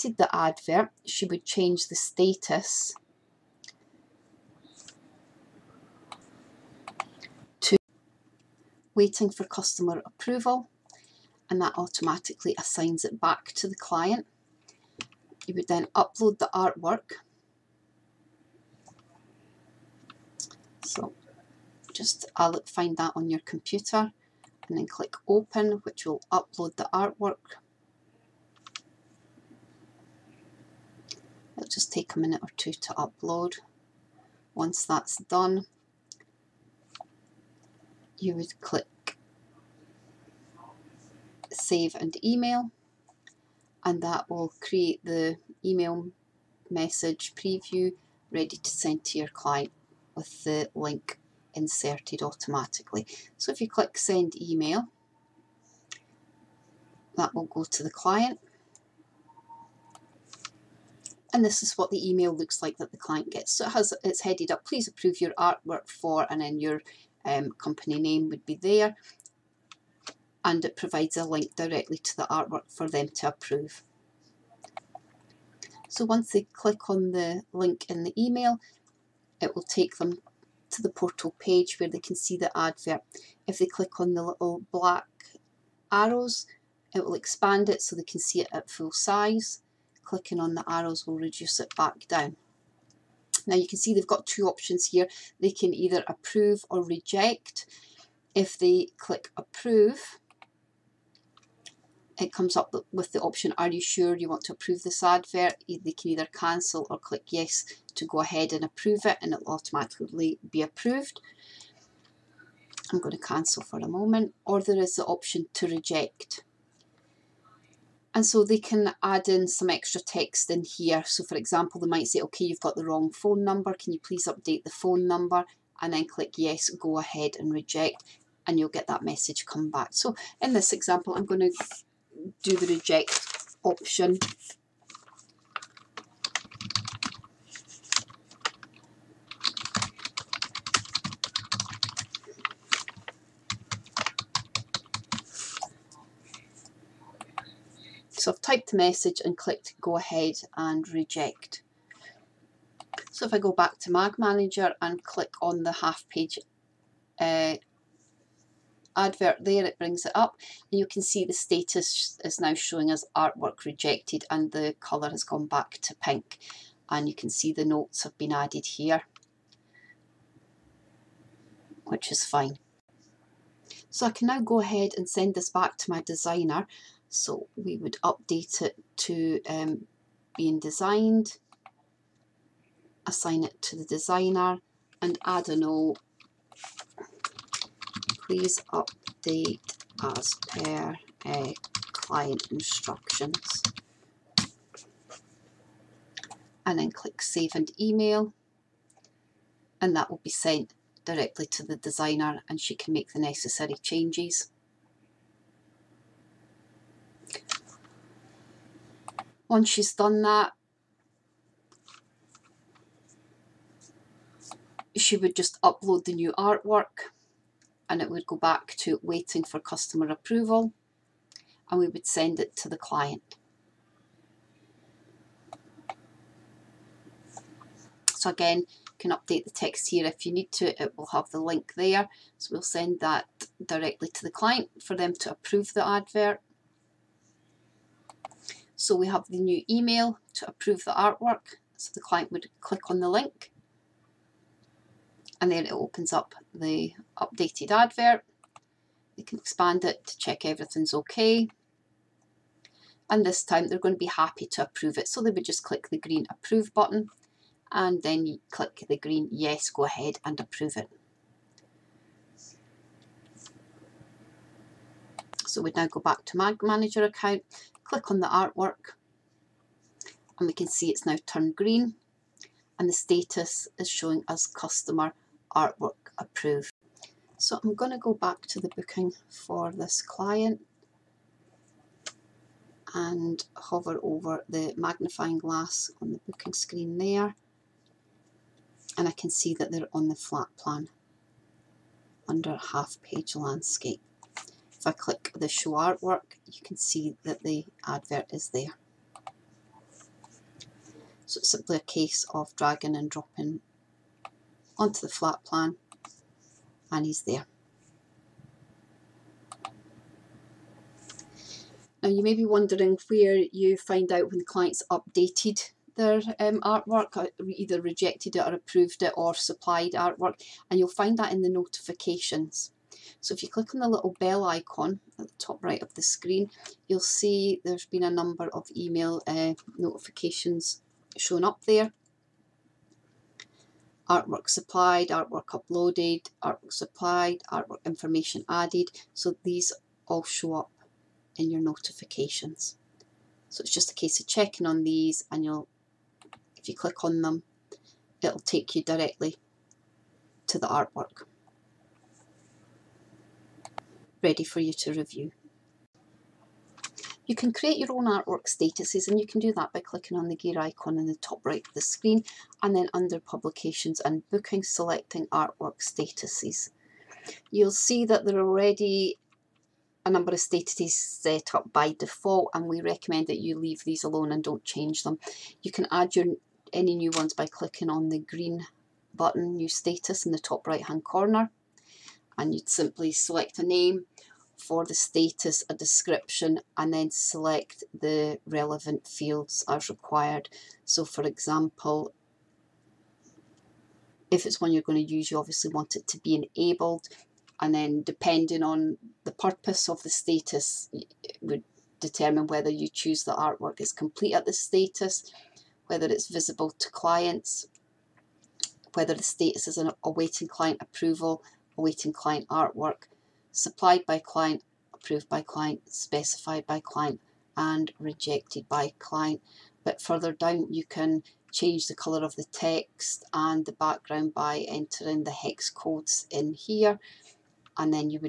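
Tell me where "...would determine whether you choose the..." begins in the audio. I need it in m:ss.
6:41.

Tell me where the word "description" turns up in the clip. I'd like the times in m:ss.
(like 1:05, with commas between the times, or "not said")
6:25.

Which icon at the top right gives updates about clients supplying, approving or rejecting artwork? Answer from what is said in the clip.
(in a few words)
Bell icon.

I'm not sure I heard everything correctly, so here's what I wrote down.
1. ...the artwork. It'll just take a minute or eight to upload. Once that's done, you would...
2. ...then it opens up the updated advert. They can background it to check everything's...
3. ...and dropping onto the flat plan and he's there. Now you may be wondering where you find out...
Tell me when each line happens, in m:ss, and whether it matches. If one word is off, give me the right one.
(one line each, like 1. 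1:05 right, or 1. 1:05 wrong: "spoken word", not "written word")
1. 0:26 wrong: "two", not "eight"
2. 4:05 wrong: "expand", not "background"
3. 5:02 right.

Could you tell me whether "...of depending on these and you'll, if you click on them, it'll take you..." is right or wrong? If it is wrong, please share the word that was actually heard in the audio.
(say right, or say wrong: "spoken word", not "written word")
wrong: "checking", not "depending".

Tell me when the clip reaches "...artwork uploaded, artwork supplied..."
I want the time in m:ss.
5:35.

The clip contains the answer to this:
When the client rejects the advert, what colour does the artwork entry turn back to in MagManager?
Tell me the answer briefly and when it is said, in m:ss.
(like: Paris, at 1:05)
Pink, at 2:45.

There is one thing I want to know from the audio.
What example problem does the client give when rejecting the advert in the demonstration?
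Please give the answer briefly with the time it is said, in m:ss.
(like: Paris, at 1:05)
Wrong phone number, at 2:02.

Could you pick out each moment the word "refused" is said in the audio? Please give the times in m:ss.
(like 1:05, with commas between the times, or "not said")
not said.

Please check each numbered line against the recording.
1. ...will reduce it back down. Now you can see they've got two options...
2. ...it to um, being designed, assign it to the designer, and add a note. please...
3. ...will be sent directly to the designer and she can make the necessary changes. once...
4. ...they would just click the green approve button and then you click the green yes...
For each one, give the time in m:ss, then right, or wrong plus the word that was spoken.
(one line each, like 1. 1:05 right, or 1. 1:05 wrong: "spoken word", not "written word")
1. 1:31 right
2. 2:58 right
3. 3:20 right
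4. 4:15 right.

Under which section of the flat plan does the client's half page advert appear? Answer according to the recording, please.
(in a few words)
Half page landscape.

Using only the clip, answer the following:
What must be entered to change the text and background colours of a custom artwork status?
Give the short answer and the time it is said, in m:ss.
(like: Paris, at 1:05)
Hex codes, at 7:05.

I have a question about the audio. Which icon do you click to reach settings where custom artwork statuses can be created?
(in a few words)
Gear icon.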